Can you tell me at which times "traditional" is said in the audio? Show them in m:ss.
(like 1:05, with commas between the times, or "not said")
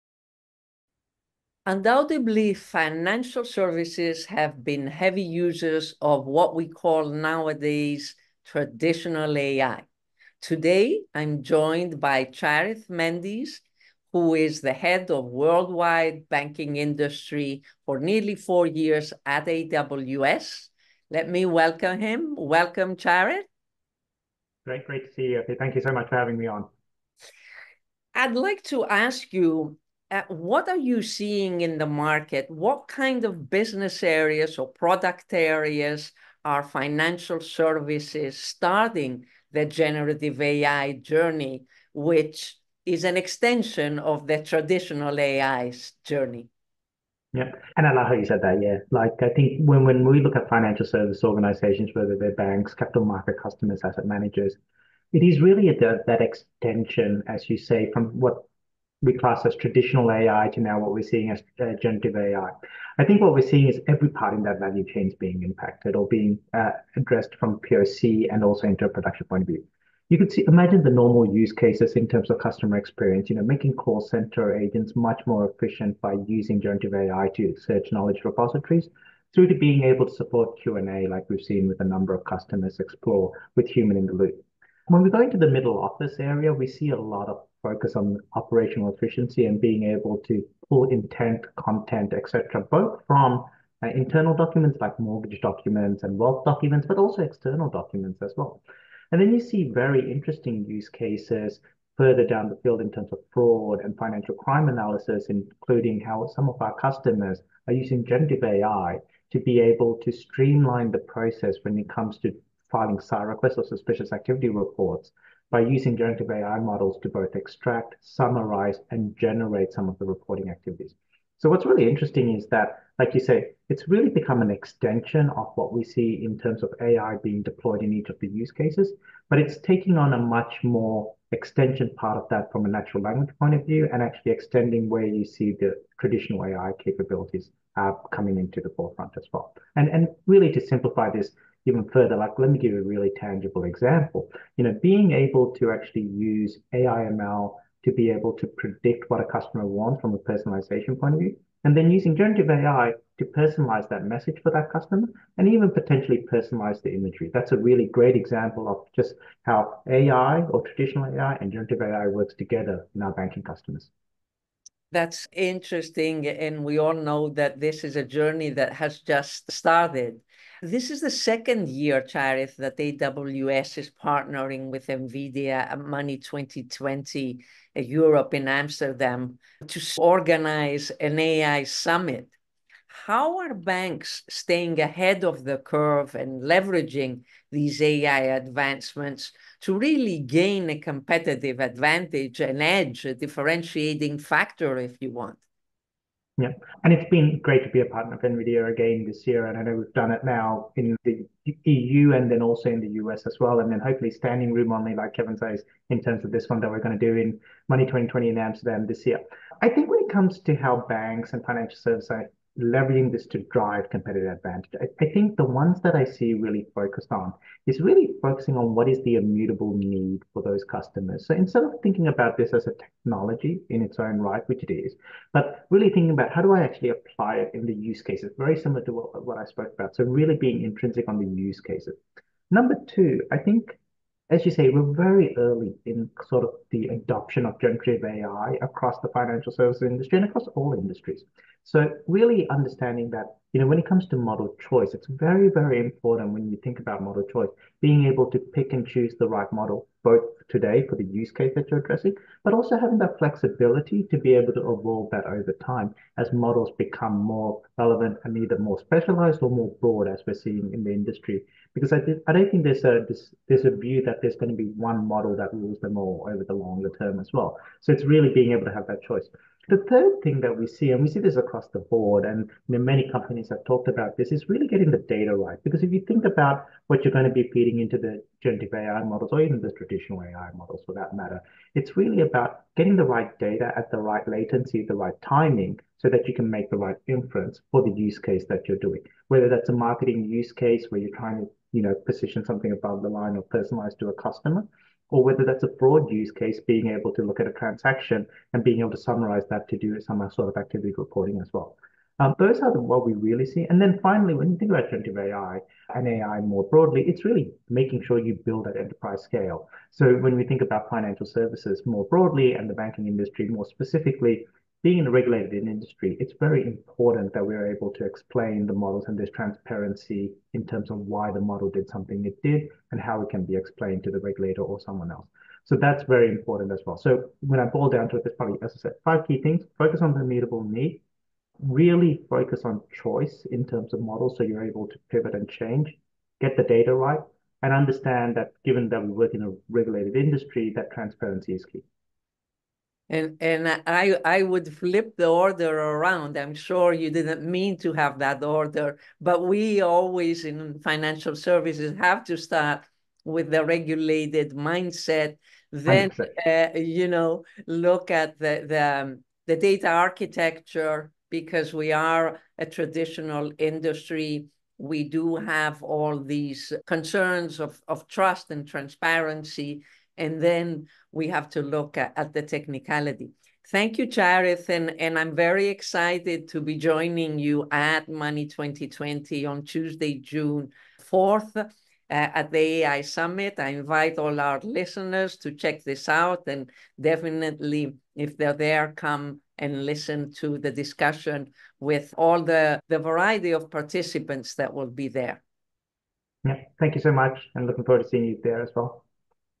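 0:08, 0:44, 0:59, 2:15, 2:40, 4:39, 6:02.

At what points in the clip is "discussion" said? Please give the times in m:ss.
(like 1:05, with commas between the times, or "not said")
6:30.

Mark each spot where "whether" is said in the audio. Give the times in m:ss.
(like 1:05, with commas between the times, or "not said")
0:51, 4:49, 4:55.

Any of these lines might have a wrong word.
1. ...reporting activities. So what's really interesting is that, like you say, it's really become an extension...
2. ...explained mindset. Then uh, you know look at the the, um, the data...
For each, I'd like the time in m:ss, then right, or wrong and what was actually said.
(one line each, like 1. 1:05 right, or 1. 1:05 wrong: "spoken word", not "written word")
1. 2:00 right
2. 5:53 wrong: "regulated", not "explained".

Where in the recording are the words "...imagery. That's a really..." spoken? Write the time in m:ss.
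2:36.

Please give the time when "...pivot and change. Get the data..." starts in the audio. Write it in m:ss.
5:35.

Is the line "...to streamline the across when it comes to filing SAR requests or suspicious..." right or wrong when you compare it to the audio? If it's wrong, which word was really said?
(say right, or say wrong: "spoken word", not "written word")
wrong: "process", not "across".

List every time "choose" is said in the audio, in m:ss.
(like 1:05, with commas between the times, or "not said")
4:08.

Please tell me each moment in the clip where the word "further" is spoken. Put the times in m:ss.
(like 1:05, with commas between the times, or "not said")
1:41, 2:21.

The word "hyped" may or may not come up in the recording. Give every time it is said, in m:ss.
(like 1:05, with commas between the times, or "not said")
not said.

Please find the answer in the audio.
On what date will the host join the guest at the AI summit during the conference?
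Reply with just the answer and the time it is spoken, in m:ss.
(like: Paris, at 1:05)
Tuesday, June 4th, at 6:19.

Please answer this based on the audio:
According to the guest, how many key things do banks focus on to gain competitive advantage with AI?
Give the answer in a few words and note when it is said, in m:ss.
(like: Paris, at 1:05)
5, at 5:29.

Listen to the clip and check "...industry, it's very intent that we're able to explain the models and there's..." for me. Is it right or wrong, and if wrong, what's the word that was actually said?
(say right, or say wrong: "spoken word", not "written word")
wrong: "important", not "intent".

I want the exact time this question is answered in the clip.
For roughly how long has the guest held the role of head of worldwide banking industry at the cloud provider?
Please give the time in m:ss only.
0:17.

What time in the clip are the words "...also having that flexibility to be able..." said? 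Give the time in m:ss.
4:12.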